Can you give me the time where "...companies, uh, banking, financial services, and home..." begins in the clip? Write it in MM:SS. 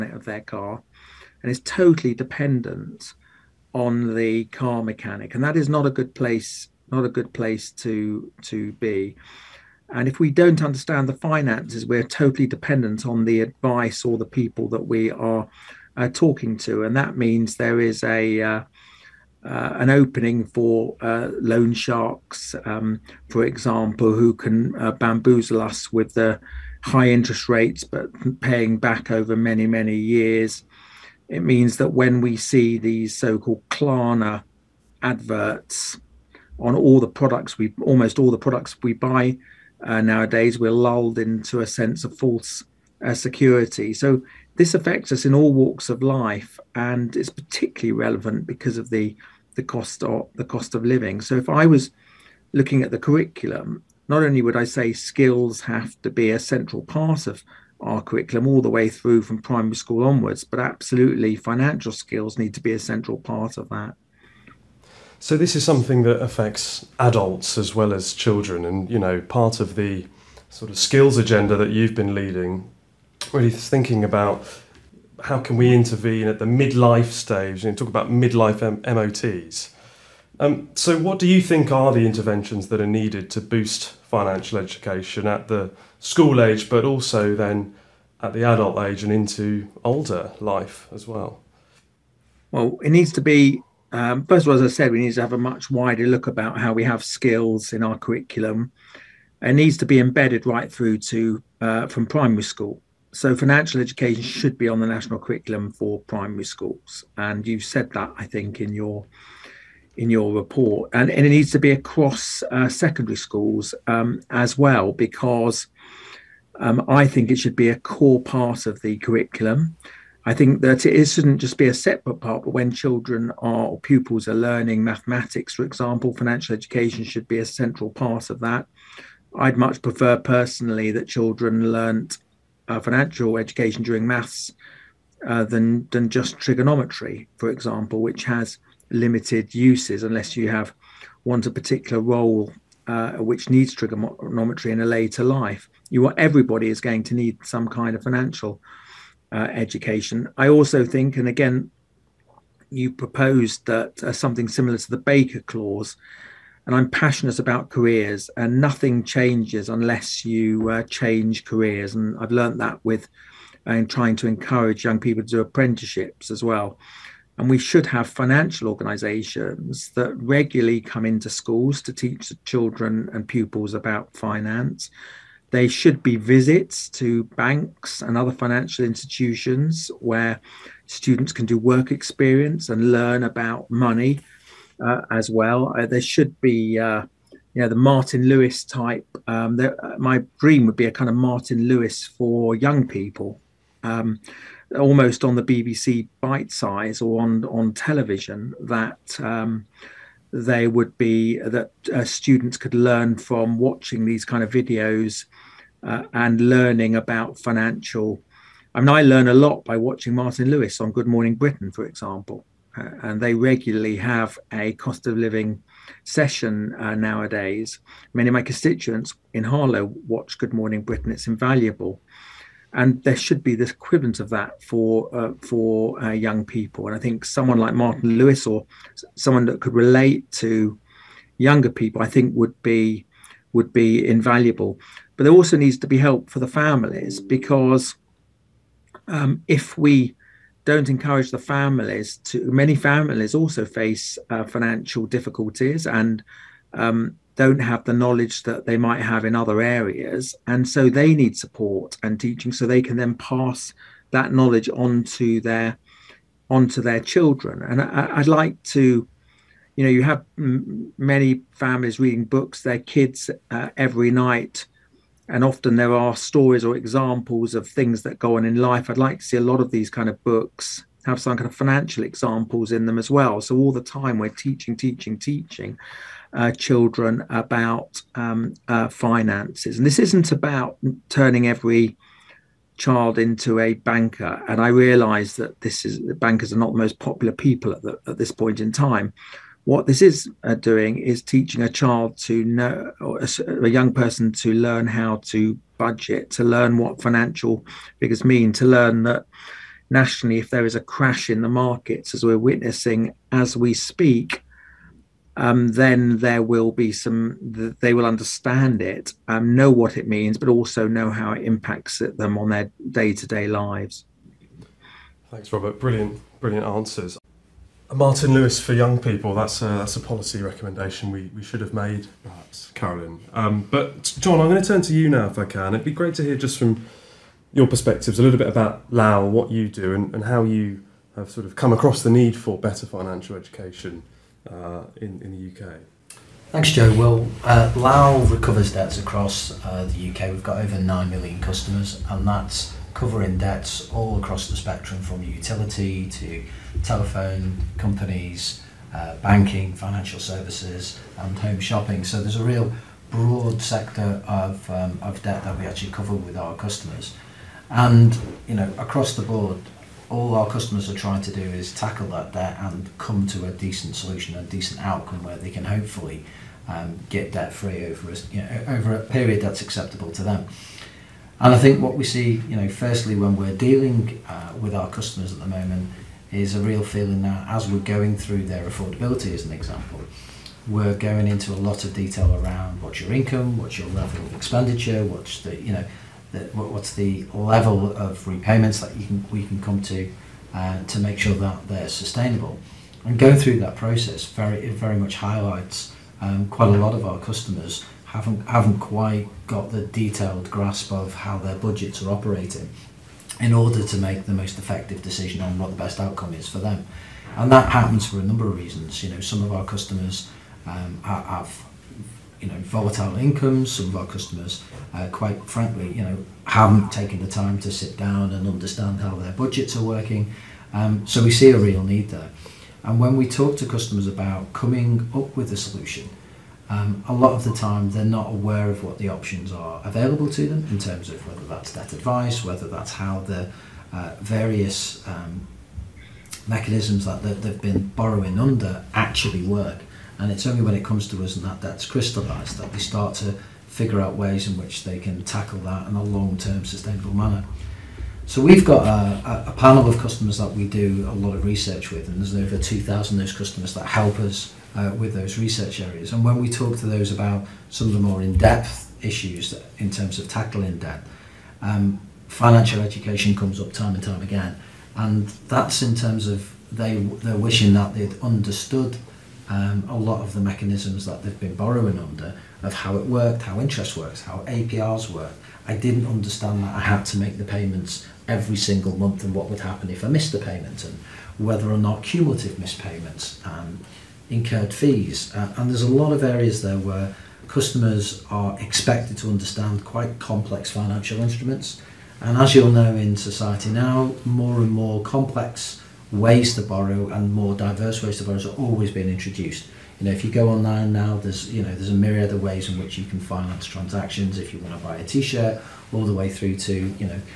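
05:47.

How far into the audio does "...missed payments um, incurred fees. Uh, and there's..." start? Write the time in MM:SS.
08:02.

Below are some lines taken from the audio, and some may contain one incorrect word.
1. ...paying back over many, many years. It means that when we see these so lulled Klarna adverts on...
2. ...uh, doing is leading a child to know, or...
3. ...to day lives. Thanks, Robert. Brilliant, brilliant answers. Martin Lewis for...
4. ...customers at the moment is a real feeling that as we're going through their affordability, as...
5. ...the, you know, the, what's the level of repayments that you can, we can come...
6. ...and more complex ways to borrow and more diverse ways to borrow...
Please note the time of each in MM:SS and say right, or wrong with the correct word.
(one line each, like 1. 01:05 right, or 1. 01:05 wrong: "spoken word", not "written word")
1. 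00:28 wrong: "called", not "lulled"
2. 04:50 wrong: "teaching", not "leading"
3. 05:13 right
4. 06:14 right
5. 06:25 right
6. 08:14 right.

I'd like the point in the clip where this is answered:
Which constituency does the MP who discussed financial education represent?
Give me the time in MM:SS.
03:39.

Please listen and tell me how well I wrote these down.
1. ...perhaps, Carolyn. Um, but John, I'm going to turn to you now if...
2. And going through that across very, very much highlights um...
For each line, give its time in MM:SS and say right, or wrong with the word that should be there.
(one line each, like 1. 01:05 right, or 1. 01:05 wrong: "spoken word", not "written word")
1. 05:22 right
2. 06:33 wrong: "process", not "across".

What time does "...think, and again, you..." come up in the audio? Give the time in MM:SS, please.
02:30.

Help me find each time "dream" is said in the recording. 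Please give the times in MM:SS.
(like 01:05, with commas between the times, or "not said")
03:10.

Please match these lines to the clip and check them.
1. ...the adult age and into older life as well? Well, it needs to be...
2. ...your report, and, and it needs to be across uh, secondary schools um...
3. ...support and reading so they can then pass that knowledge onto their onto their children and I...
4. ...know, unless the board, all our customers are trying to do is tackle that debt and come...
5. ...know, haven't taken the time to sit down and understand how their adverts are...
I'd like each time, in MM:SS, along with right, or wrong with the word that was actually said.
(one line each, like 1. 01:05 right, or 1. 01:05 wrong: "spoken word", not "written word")
1. 01:28 right
2. 01:50 right
3. 04:11 wrong: "teaching", not "reading"
4. 05:58 wrong: "across", not "unless"
5. 06:56 wrong: "budgets", not "adverts".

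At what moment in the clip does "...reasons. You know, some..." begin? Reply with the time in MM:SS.
06:48.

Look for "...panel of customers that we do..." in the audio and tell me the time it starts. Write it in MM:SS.
07:29.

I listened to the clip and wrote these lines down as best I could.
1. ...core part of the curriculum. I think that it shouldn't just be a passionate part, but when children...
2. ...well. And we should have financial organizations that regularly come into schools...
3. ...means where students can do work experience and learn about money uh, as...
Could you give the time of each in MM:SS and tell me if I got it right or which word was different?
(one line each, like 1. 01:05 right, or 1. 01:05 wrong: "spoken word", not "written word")
1. 01:57 wrong: "separate", not "passionate"
2. 02:46 right
3. 02:58 wrong: "institutions", not "means".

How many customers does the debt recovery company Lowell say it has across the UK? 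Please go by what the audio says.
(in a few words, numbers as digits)
over 9 million.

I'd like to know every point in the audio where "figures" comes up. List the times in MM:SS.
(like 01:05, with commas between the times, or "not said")
04:57, 07:23.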